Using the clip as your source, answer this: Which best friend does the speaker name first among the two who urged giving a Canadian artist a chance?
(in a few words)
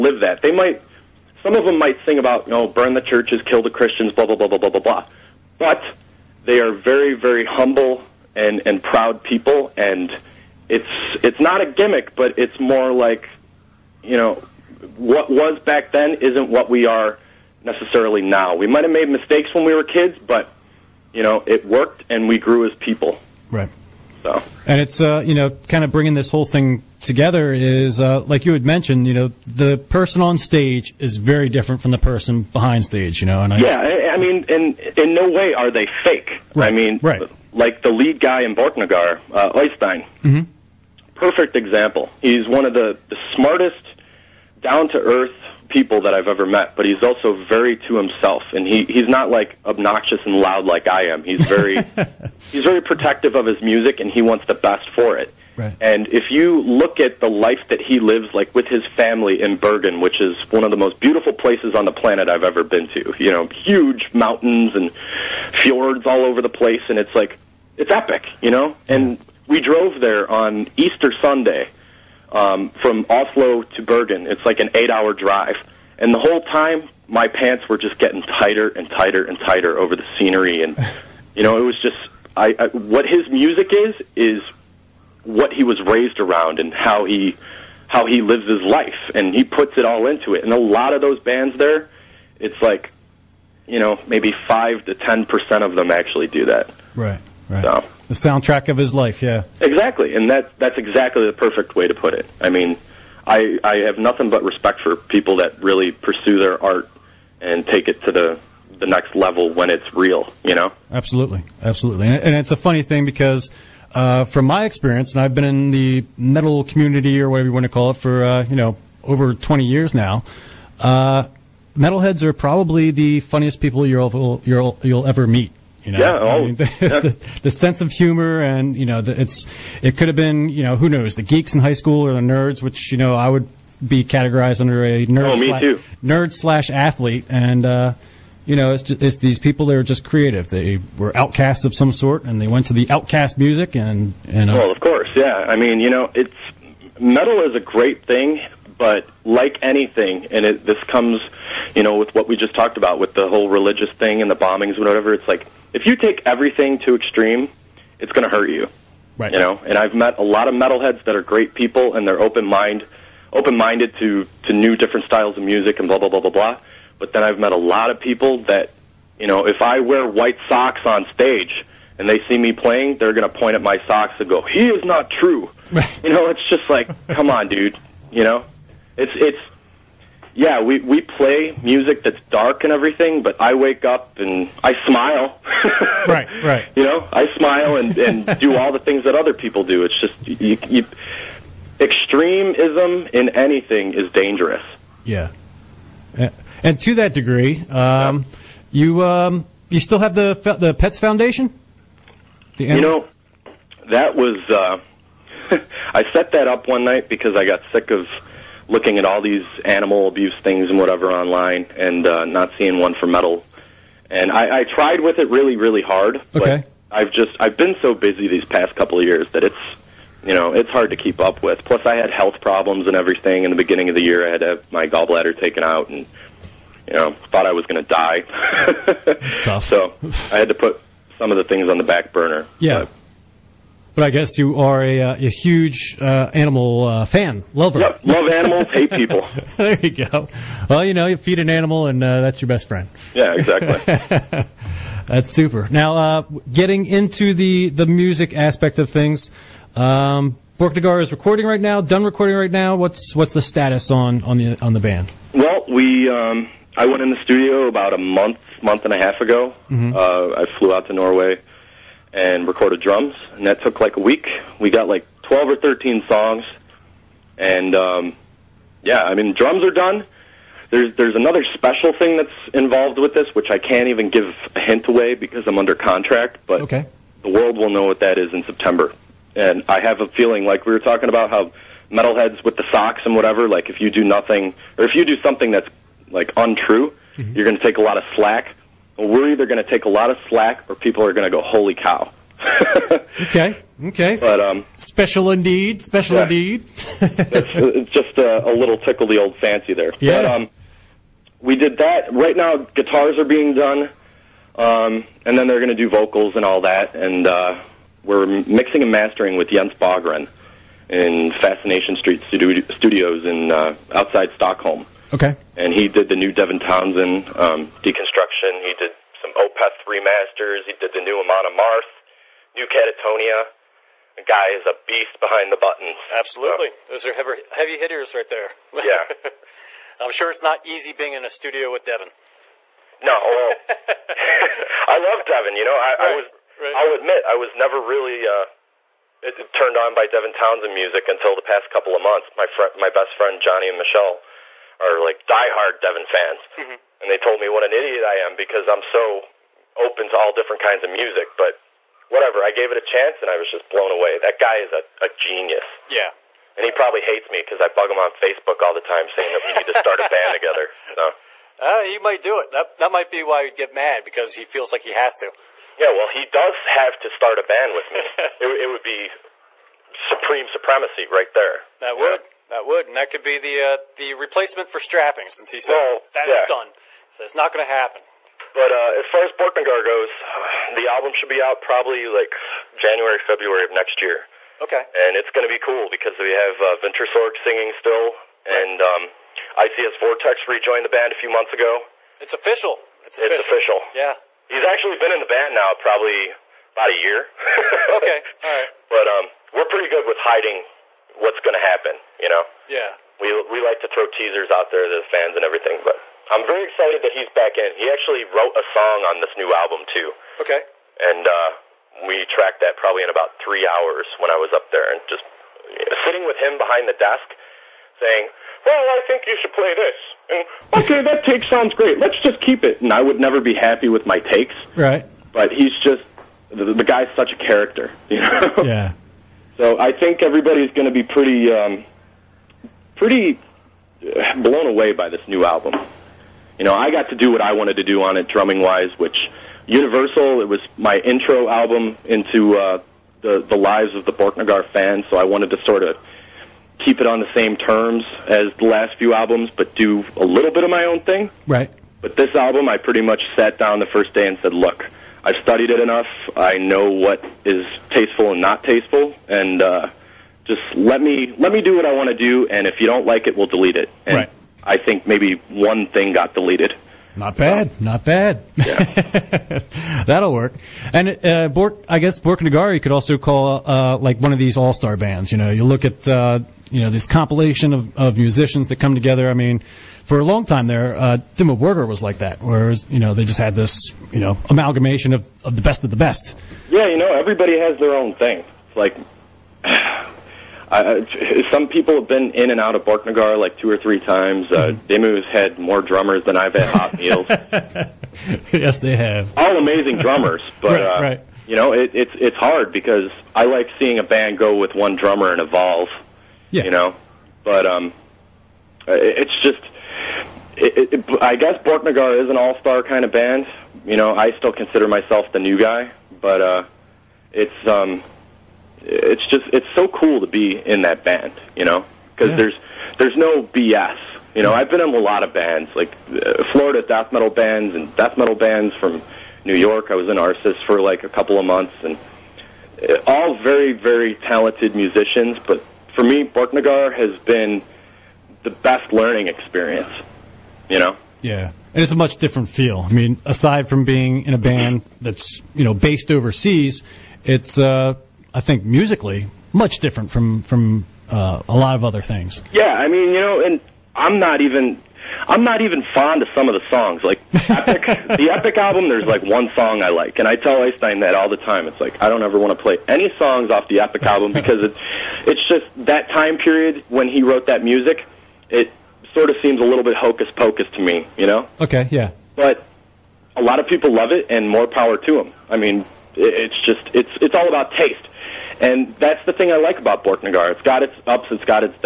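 Johnny.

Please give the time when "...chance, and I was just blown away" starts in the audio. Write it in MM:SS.
05:52.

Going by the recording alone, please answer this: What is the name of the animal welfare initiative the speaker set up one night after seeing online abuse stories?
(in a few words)
Pets Foundation.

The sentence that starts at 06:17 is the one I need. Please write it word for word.
So it's not going to happen.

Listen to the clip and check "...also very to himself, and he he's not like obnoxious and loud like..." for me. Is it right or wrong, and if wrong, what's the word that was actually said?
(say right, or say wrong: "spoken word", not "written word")
right.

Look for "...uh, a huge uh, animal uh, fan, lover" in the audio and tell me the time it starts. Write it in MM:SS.
03:54.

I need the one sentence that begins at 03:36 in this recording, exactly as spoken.
but I've just I've been so busy these past couple of years that it's you know it's hard to keep up with.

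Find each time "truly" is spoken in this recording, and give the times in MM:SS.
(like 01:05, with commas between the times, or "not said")
not said.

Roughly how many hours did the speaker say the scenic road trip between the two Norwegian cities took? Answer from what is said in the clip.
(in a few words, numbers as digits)
8.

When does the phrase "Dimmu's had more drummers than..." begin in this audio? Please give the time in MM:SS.
08:14.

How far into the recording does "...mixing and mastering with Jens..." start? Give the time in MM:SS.
05:08.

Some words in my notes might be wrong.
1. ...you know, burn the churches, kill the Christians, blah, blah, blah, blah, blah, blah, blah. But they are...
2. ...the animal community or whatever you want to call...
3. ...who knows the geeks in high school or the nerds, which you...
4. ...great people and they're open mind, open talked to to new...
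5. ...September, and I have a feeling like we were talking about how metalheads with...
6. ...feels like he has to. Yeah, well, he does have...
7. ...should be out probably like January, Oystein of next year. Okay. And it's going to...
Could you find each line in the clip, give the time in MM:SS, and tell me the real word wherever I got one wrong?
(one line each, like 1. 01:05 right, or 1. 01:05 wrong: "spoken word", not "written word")
1. 00:02 right
2. 01:55 wrong: "metal", not "animal"
3. 02:10 right
4. 02:41 wrong: "minded", not "talked"
5. 04:38 right
6. 06:04 right
7. 06:21 wrong: "February", not "Oystein".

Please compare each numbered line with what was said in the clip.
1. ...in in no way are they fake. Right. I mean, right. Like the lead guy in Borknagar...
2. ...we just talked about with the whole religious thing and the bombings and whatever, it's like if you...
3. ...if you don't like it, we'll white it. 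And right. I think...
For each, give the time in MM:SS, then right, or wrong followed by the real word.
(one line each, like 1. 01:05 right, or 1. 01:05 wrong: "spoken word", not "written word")
1. 00:34 right
2. 02:32 right
3. 07:42 wrong: "delete", not "white".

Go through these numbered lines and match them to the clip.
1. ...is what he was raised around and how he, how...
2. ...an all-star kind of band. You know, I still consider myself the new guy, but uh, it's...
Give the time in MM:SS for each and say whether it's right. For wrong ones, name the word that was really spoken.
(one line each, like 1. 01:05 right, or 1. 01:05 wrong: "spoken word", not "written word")
1. 01:24 right
2. 08:32 right.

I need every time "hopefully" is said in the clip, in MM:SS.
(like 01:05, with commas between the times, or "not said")
not said.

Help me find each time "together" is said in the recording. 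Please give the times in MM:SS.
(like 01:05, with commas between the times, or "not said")
00:26, 06:00, 07:58.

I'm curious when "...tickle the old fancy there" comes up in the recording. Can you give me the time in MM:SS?
04:58.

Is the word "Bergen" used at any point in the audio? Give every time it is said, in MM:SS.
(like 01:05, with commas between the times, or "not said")
00:59, 01:13.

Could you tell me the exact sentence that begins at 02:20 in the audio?
They were outcasts of some sort, and they went to the outcast music, and and.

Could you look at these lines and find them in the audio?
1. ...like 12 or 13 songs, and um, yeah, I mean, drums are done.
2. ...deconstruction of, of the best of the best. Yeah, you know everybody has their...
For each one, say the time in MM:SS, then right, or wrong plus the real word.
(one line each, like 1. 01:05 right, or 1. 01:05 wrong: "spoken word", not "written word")
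1. 04:24 right
2. 08:04 wrong: "amalgamation", not "deconstruction".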